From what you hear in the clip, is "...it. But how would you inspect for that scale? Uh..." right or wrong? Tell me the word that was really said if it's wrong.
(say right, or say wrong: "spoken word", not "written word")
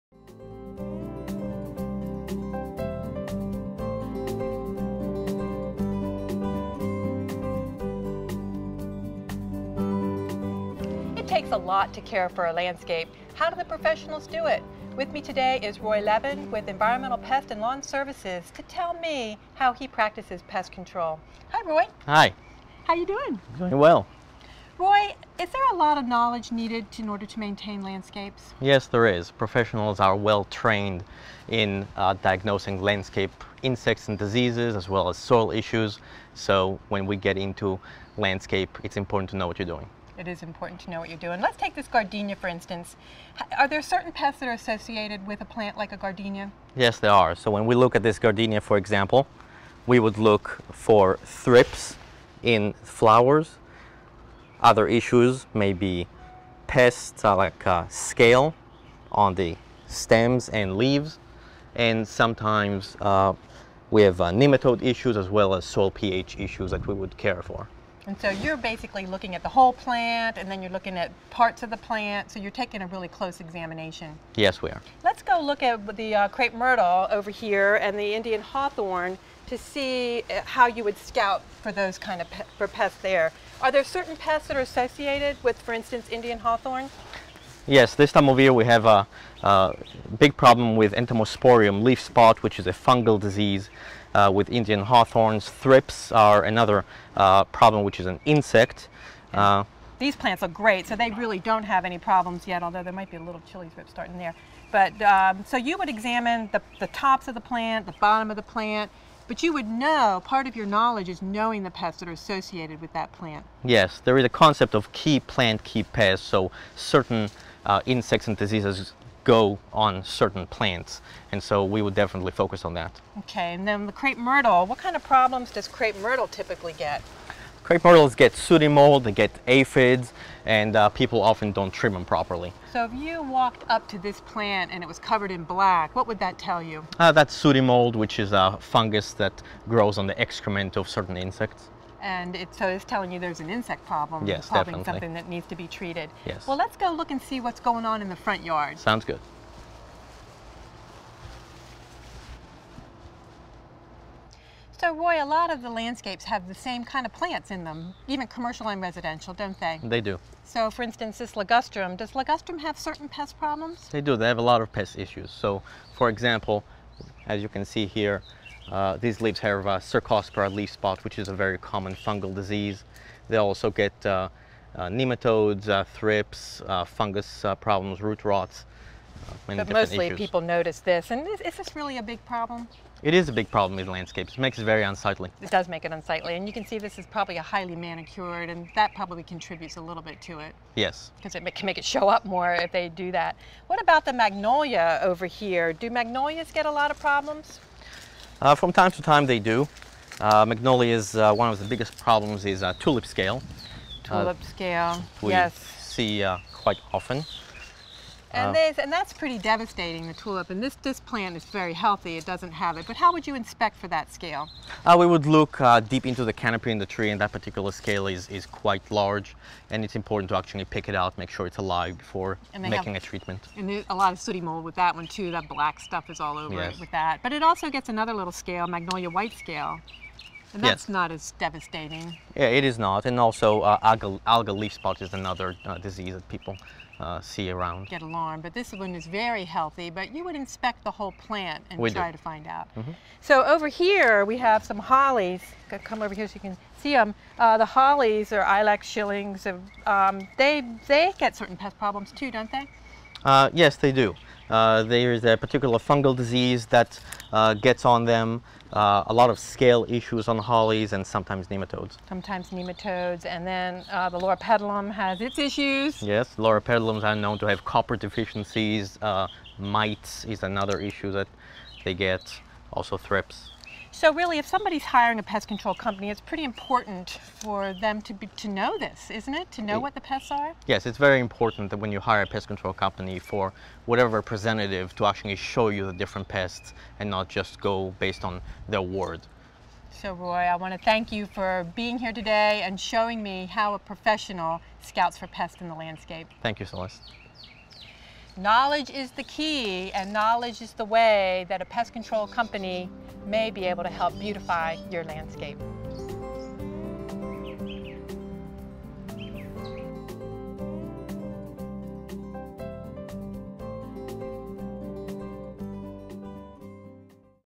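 right.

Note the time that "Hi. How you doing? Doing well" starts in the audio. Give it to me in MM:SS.
00:22.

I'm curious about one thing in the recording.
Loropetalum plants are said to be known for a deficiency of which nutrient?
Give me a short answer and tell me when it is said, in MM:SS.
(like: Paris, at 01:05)
Copper, at 04:27.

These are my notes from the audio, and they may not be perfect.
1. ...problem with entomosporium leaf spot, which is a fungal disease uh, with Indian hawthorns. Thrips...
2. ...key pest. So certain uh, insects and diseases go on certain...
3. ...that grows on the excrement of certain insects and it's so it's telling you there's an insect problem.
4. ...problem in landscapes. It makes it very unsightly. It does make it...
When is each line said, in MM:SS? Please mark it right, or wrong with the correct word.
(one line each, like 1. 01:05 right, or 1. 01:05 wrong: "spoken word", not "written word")
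1. 01:30 right
2. 01:55 right
3. 02:19 right
4. 03:03 right.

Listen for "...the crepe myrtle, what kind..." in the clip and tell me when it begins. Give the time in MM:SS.
02:03.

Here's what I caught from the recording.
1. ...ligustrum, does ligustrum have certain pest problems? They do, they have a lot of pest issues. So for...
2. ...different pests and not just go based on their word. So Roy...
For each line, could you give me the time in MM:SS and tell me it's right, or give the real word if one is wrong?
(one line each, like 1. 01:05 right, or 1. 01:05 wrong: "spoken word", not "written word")
1. 02:41 right
2. 04:45 right.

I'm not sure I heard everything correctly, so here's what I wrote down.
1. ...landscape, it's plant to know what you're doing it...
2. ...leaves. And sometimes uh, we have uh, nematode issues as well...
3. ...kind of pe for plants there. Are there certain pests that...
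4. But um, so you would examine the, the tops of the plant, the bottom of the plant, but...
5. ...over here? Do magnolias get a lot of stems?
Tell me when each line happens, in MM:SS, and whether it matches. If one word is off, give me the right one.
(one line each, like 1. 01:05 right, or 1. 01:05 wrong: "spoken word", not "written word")
1. 00:38 wrong: "important", not "plant"
2. 01:00 right
3. 01:21 wrong: "pests", not "plants"
4. 01:44 right
5. 03:15 wrong: "problems", not "stems".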